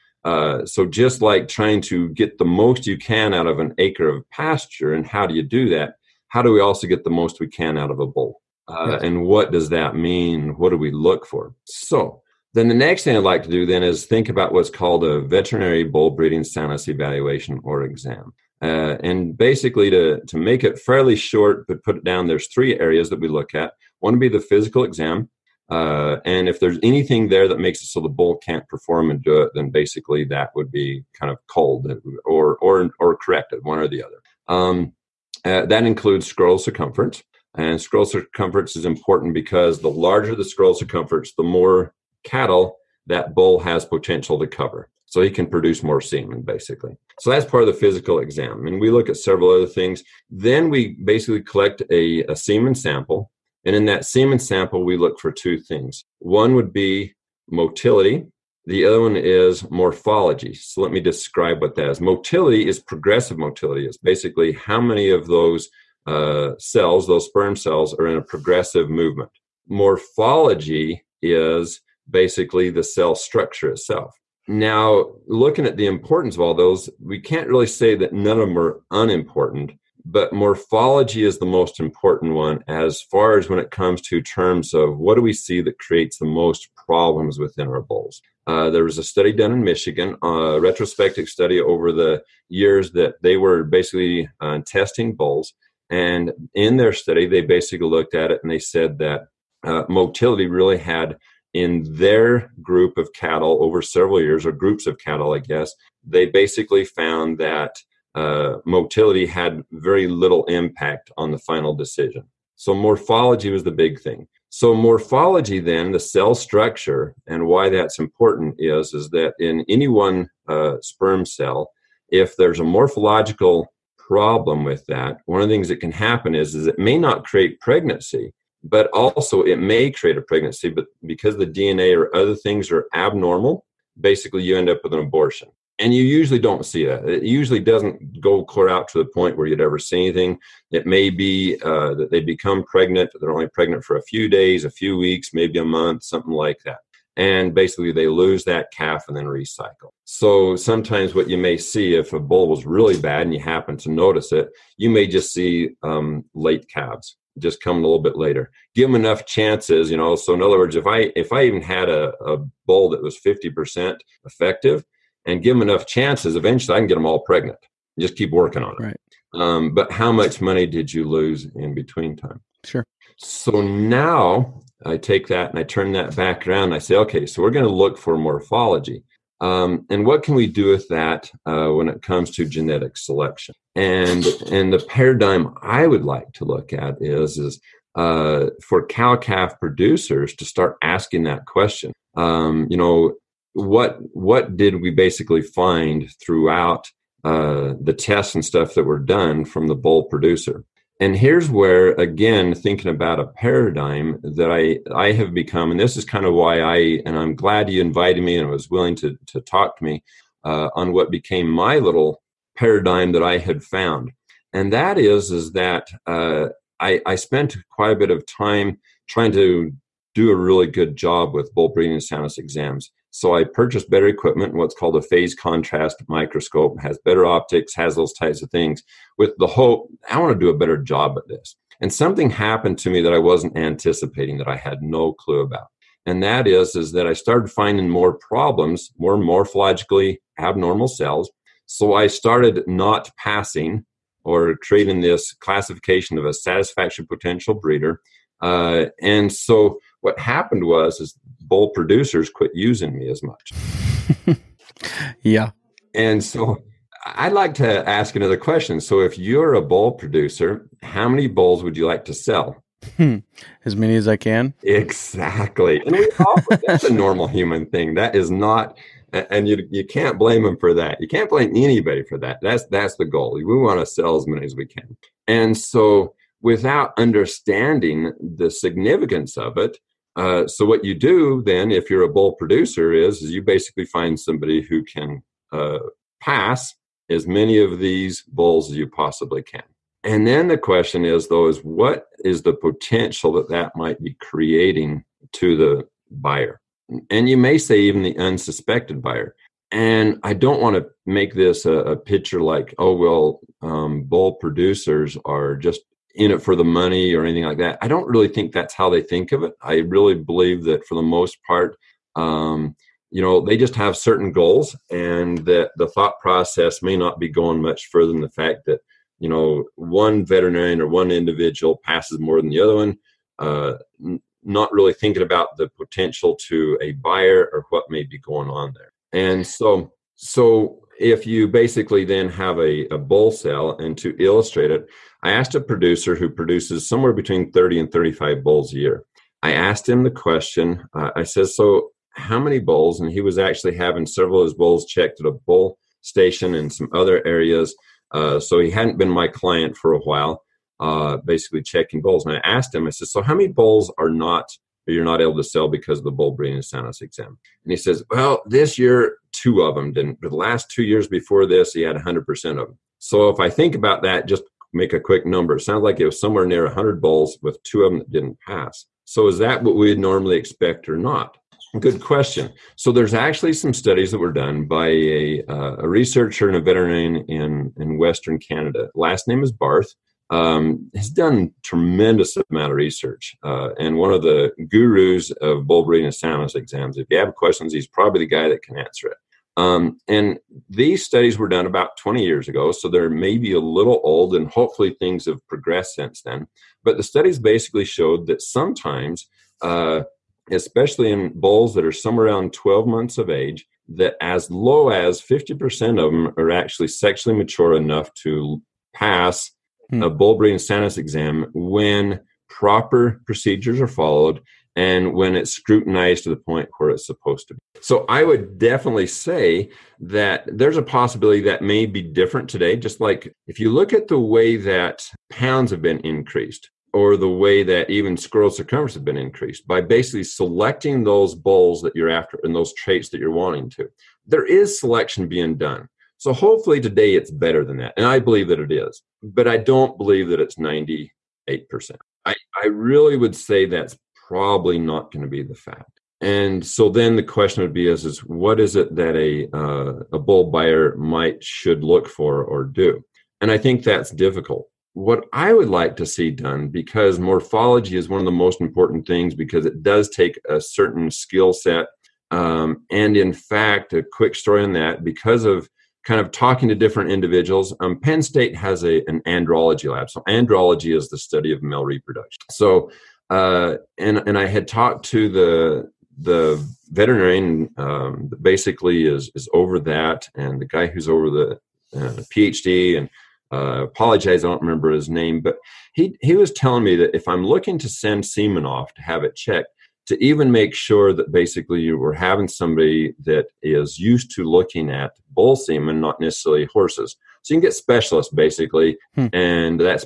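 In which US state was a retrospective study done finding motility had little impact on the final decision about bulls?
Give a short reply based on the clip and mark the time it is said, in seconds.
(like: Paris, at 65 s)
Michigan, at 89 s.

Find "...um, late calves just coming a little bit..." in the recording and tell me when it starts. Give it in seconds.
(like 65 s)
155 s.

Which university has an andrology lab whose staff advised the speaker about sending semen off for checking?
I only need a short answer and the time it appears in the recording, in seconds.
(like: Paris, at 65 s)
Penn State, at 467 s.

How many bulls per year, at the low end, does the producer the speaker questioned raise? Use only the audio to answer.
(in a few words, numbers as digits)
30.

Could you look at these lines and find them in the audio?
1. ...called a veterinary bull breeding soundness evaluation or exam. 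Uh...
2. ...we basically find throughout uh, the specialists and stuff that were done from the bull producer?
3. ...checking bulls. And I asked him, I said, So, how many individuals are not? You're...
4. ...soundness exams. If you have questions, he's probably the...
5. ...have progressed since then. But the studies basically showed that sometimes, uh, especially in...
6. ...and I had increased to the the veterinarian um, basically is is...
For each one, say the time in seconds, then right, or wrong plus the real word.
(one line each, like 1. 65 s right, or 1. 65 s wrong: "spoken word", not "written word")
1. 14 s right
2. 194 s wrong: "tests", not "specialists"
3. 351 s wrong: "bulls", not "individuals"
4. 386 s right
5. 395 s right
6. 474 s wrong: "talked", not "increased".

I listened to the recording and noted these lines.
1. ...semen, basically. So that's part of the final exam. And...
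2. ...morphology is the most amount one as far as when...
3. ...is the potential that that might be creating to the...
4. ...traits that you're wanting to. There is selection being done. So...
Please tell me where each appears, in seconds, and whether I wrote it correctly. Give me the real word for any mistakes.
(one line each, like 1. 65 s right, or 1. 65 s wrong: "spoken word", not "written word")
1. 45 s wrong: "physical", not "final"
2. 80 s wrong: "important", not "amount"
3. 292 s right
4. 432 s right.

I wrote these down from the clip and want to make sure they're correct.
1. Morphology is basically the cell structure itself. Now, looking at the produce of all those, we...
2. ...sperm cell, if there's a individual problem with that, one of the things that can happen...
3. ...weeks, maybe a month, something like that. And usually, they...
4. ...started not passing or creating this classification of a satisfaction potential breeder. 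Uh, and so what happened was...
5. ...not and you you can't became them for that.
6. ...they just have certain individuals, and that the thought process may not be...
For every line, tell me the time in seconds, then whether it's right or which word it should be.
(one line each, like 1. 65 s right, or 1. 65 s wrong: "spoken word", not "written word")
1. 69 s wrong: "importance", not "produce"
2. 120 s wrong: "morphological", not "individual"
3. 144 s wrong: "basically", not "usually"
4. 242 s right
5. 268 s wrong: "blame", not "became"
6. 313 s wrong: "goals", not "individuals".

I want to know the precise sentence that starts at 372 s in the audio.
So there's actually some studies that were done by a, uh, a researcher and a veterinarian in, in Western Canada.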